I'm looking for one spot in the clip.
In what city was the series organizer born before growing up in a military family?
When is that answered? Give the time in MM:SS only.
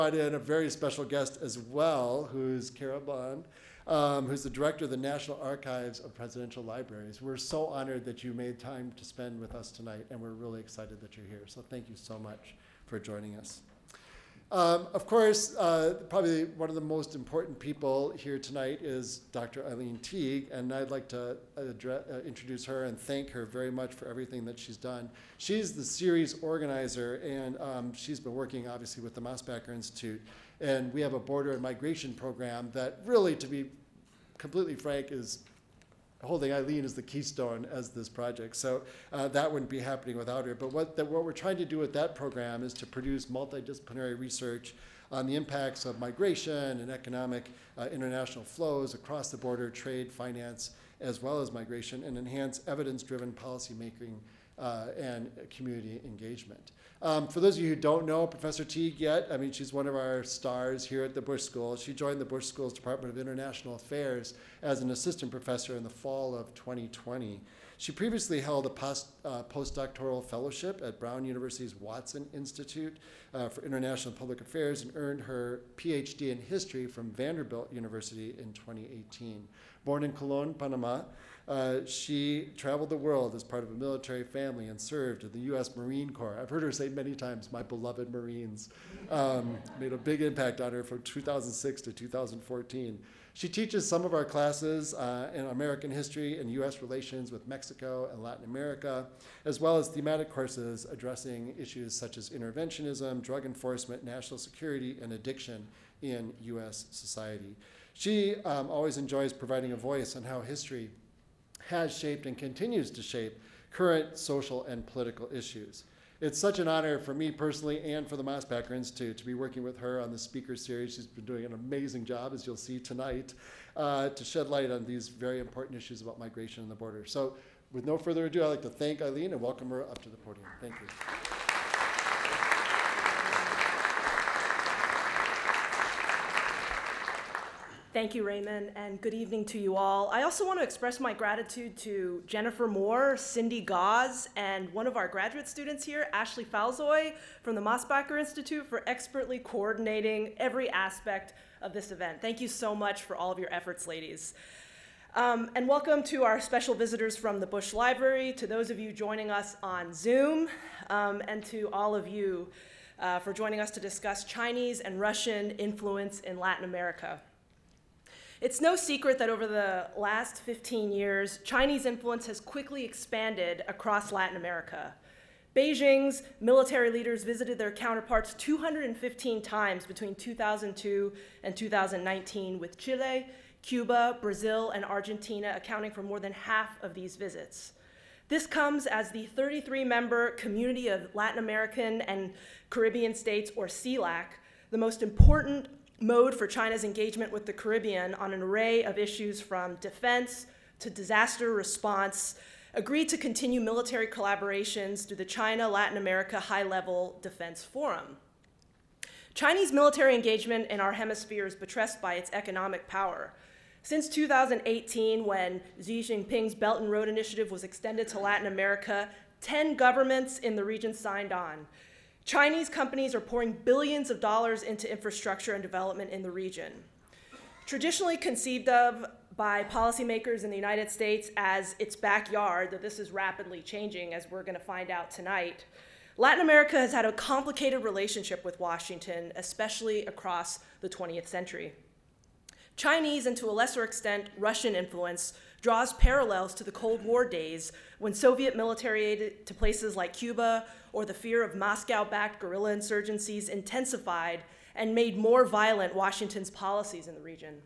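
01:20.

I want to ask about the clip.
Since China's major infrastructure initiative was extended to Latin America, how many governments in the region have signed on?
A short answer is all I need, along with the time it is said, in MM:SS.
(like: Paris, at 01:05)
10, at 03:39.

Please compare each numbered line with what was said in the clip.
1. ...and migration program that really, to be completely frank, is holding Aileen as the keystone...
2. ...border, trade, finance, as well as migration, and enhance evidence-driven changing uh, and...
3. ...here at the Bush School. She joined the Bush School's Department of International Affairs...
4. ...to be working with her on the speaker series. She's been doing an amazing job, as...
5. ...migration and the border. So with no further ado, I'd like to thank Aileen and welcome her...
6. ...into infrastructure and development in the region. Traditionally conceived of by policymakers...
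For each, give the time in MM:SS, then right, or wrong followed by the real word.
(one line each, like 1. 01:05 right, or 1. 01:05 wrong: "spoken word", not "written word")
1. 00:31 right
2. 00:49 wrong: "policymaking", not "changing"
3. 01:00 right
4. 01:59 right
5. 02:06 right
6. 03:44 right.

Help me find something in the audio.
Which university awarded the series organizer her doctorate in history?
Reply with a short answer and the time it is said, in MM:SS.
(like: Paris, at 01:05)
Vanderbilt University, at 01:17.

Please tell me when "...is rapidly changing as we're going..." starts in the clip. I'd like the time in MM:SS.
03:52.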